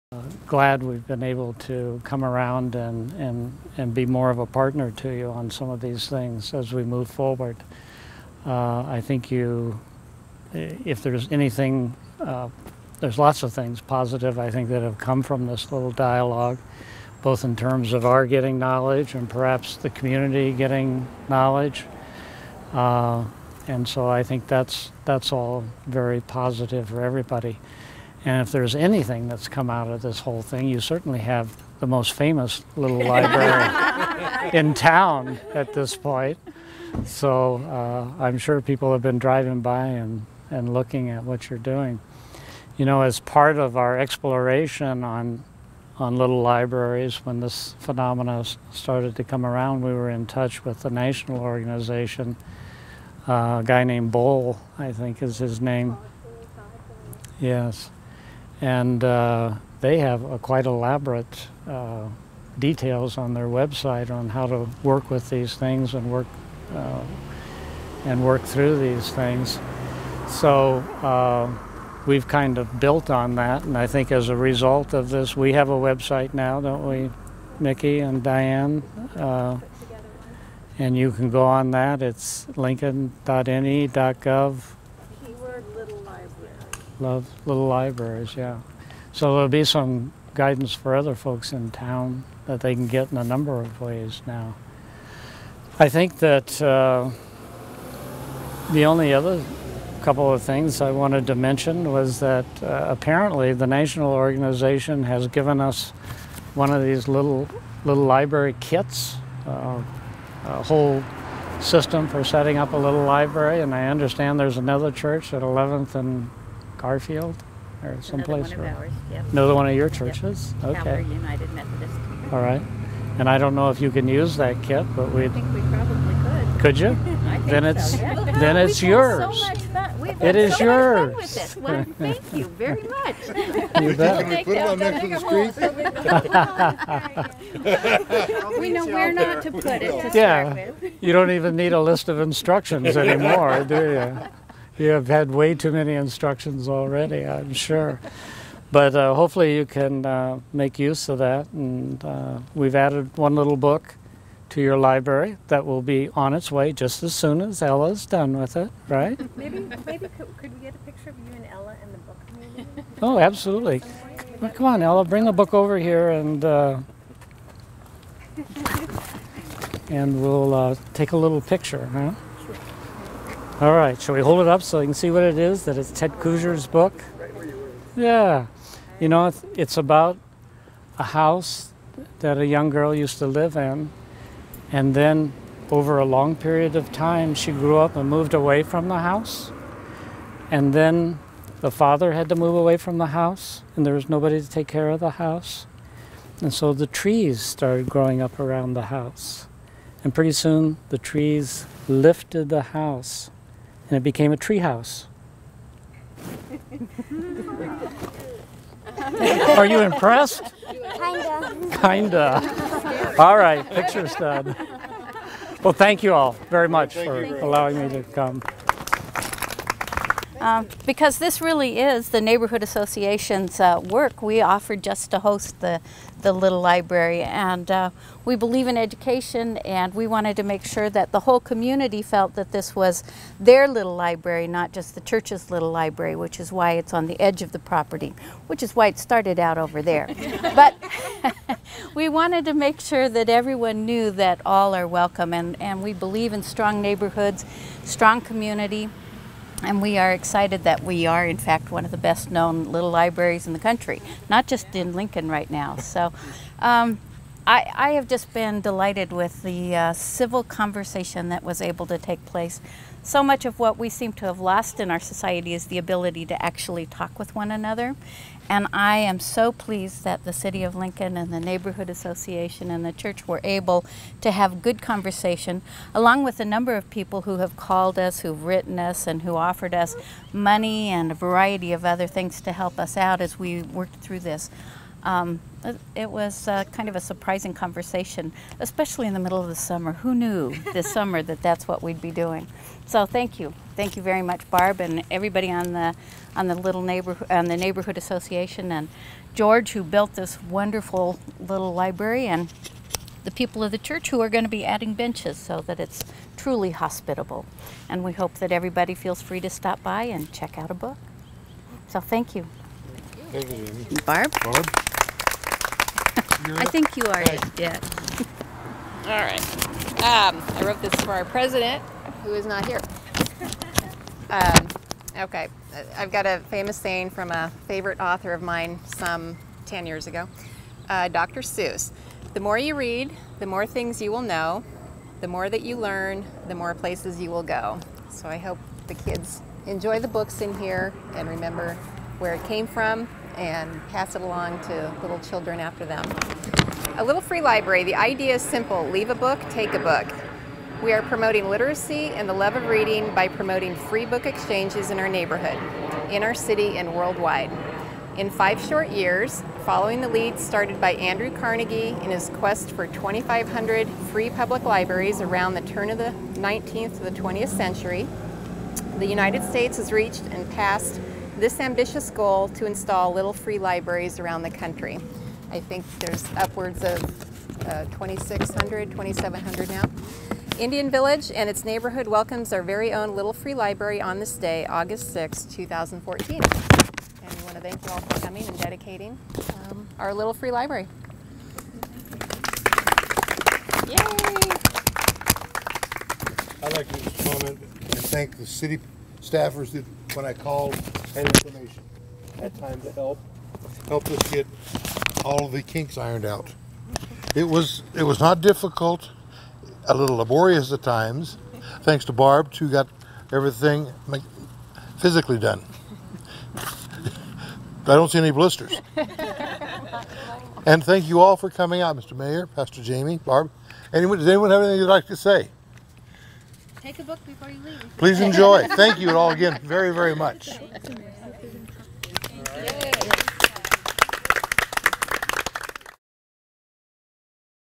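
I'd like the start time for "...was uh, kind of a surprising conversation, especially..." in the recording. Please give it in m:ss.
4:46.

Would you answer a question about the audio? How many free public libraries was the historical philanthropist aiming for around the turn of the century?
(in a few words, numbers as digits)
2,500.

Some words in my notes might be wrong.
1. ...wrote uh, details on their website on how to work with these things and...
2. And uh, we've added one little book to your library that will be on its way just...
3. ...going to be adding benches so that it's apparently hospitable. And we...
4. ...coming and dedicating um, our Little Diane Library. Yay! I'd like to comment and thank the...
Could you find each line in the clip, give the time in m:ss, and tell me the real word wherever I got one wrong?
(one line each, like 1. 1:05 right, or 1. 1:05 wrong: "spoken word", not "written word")
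1. 1:00 wrong: "elaborate", not "wrote"
2. 2:31 right
3. 5:04 wrong: "truly", not "apparently"
4. 6:28 wrong: "Free", not "Diane".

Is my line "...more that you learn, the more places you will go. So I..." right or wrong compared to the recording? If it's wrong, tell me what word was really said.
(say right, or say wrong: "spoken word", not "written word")
right.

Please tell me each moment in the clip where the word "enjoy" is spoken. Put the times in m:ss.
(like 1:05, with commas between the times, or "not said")
5:39, 7:08.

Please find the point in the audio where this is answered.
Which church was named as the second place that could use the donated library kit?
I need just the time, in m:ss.
2:00.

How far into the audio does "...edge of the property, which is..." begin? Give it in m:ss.
3:57.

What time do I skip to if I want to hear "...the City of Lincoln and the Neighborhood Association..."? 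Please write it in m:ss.
4:30.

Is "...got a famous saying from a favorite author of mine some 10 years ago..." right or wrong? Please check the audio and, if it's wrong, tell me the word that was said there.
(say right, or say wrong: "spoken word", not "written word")
right.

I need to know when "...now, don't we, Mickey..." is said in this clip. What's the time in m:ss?
1:16.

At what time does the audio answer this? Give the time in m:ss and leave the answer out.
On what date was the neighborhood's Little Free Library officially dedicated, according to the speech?
6:24.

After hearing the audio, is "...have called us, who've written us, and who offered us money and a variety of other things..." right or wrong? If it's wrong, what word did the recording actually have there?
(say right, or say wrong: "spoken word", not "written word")
right.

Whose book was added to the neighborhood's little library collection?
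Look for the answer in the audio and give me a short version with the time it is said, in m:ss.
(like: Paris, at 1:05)
Ted Kooser, at 2:55.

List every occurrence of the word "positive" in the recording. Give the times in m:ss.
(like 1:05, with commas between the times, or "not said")
0:13, 0:26.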